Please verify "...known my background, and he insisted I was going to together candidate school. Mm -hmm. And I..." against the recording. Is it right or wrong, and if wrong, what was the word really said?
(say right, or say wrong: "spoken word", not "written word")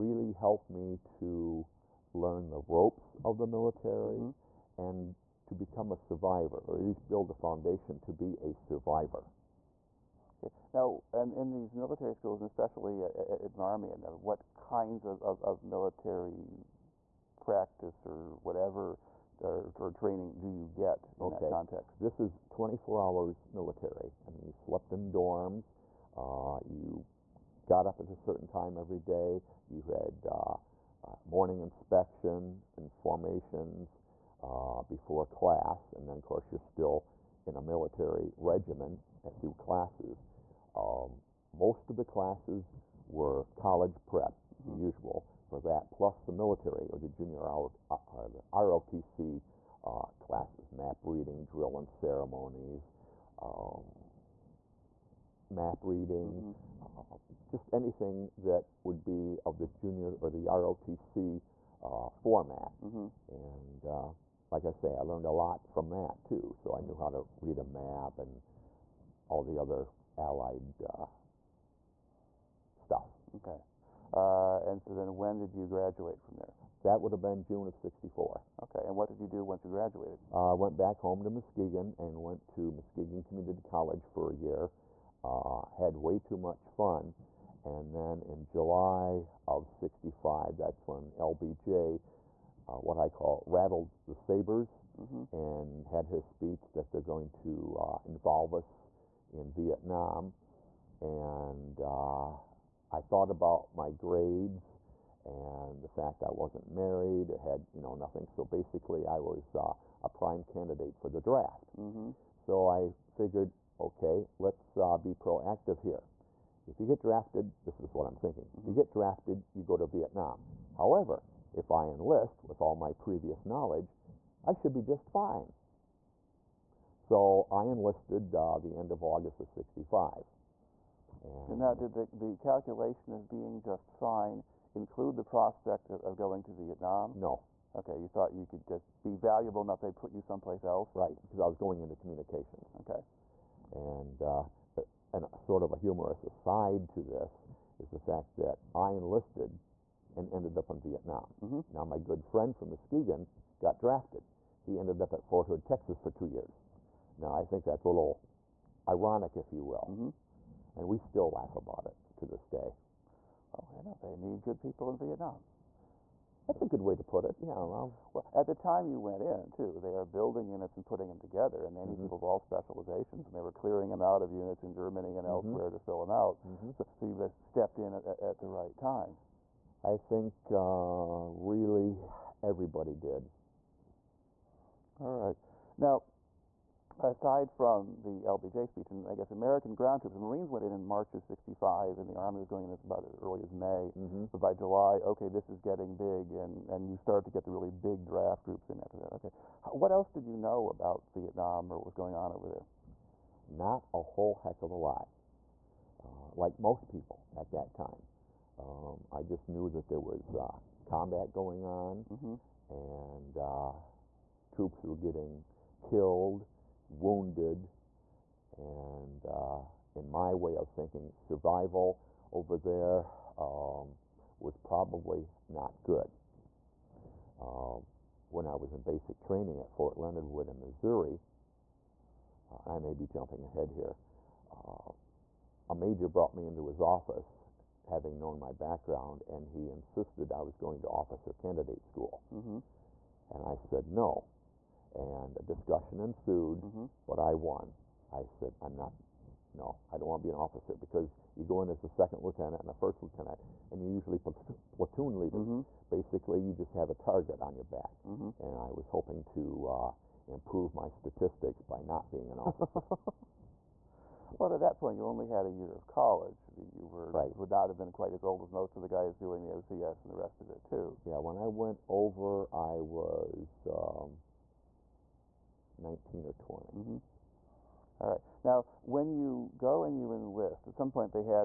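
wrong: "officer", not "together".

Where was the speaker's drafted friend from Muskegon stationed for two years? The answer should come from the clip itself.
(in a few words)
Fort Hood, Texas.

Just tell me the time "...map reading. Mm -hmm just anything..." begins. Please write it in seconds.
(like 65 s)
55 s.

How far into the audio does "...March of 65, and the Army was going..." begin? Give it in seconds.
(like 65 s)
190 s.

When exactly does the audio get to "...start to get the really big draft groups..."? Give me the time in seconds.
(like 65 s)
196 s.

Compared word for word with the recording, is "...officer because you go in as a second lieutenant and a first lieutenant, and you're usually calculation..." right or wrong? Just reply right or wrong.
wrong.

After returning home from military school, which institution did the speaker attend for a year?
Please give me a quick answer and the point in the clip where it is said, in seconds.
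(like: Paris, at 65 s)
Muskegon Community College, at 82 s.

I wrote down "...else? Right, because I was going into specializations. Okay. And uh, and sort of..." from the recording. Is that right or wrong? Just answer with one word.
wrong.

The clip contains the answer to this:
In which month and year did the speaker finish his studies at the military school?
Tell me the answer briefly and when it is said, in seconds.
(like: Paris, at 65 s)
June 1964, at 77 s.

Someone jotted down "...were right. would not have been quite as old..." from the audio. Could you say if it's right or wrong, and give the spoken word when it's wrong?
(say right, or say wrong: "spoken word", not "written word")
right.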